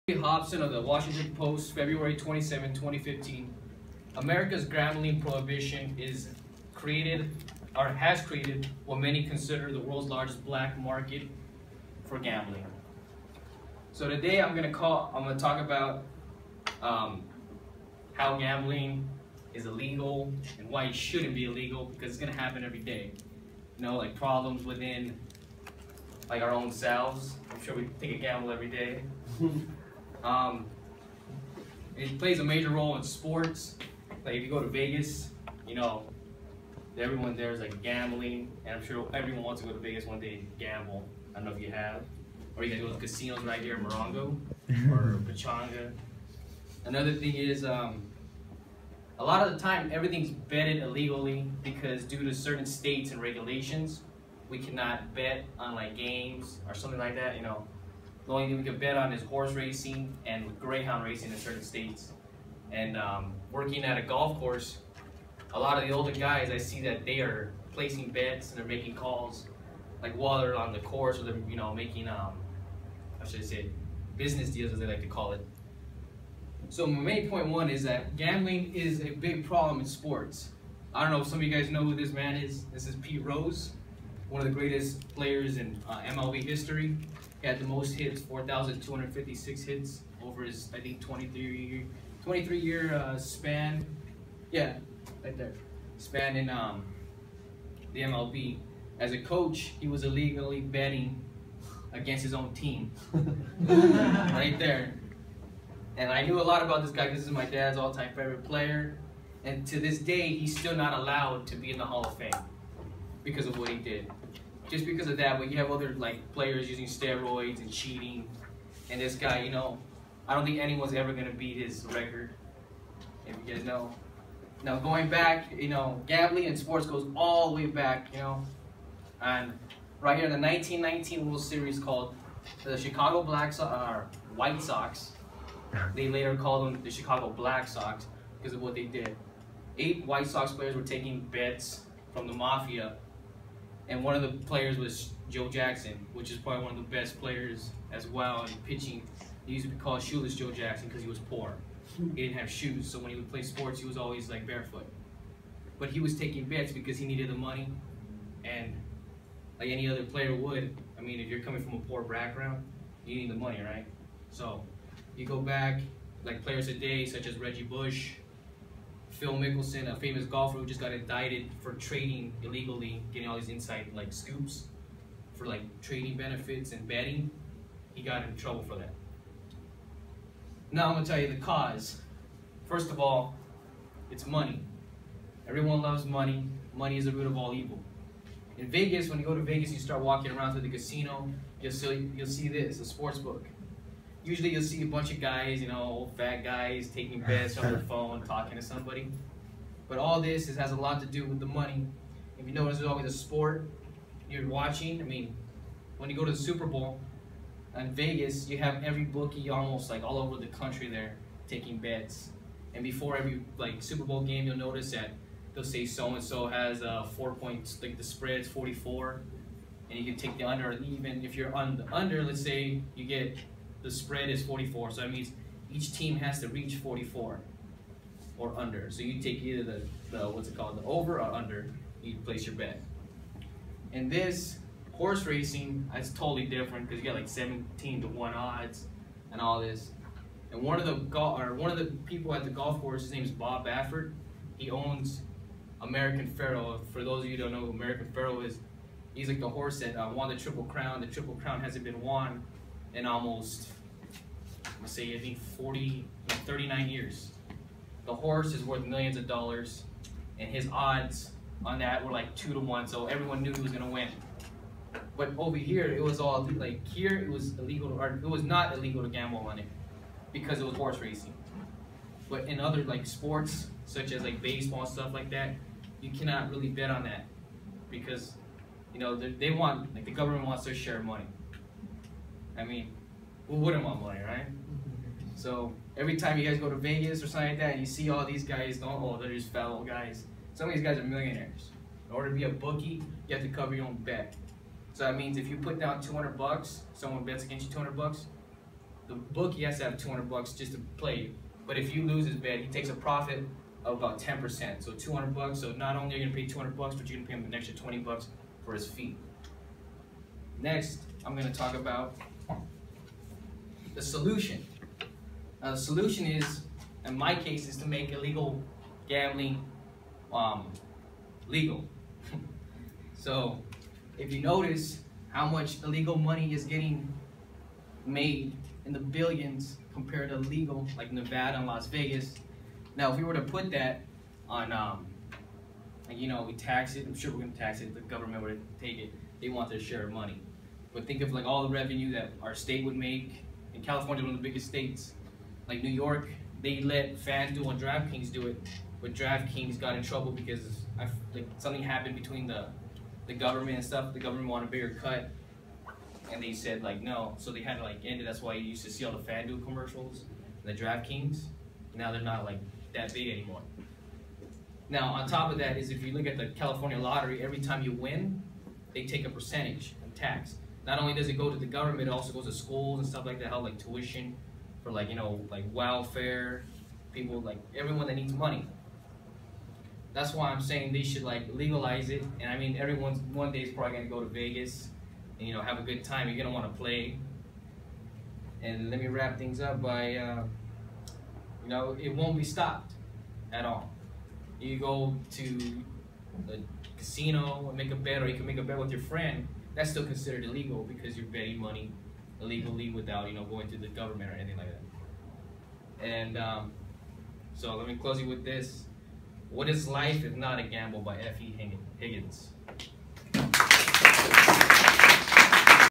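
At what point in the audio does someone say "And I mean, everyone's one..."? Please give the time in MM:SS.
06:22.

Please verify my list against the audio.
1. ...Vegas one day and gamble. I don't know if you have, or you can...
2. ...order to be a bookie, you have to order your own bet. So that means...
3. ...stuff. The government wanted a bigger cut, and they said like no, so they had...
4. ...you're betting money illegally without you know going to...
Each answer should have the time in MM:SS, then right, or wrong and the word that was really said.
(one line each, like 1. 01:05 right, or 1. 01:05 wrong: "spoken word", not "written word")
1. 00:39 right
2. 04:52 wrong: "cover", not "order"
3. 05:53 right
4. 06:41 right.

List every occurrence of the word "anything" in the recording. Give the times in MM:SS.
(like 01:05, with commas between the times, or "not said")
06:44.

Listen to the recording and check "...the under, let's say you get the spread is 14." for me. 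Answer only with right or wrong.
wrong.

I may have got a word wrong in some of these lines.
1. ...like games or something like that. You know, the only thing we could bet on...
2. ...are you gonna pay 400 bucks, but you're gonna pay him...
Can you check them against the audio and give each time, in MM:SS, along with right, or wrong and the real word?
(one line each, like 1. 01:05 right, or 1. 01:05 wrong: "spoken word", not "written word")
1. 00:55 right
2. 05:06 wrong: "200", not "400".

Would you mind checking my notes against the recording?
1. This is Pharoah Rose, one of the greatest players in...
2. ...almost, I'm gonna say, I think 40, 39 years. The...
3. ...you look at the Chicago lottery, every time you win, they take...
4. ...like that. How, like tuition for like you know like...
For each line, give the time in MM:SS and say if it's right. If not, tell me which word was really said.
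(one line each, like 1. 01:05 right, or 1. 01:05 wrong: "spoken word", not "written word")
1. 01:22 wrong: "Pete", not "Pharoah"
2. 04:13 right
3. 06:06 wrong: "California", not "Chicago"
4. 06:13 right.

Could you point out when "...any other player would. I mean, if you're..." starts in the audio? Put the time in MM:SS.
02:39.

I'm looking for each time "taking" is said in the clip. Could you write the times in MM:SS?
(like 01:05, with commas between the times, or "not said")
02:20, 02:36, 03:16, 03:31.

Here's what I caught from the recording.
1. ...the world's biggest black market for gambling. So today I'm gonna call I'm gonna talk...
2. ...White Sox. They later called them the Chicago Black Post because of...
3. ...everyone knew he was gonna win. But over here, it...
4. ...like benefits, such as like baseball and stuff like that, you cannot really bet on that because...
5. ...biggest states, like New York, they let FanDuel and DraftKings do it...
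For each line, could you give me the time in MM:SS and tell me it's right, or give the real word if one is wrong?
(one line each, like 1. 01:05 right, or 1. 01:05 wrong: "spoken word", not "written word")
1. 00:09 wrong: "largest", not "biggest"
2. 02:14 wrong: "Sox", not "Post"
3. 04:23 right
4. 04:32 wrong: "sports", not "benefits"
5. 05:44 right.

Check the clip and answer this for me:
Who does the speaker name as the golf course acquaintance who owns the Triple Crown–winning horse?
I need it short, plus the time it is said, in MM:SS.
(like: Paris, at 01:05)
Bob Baffert, at 04:03.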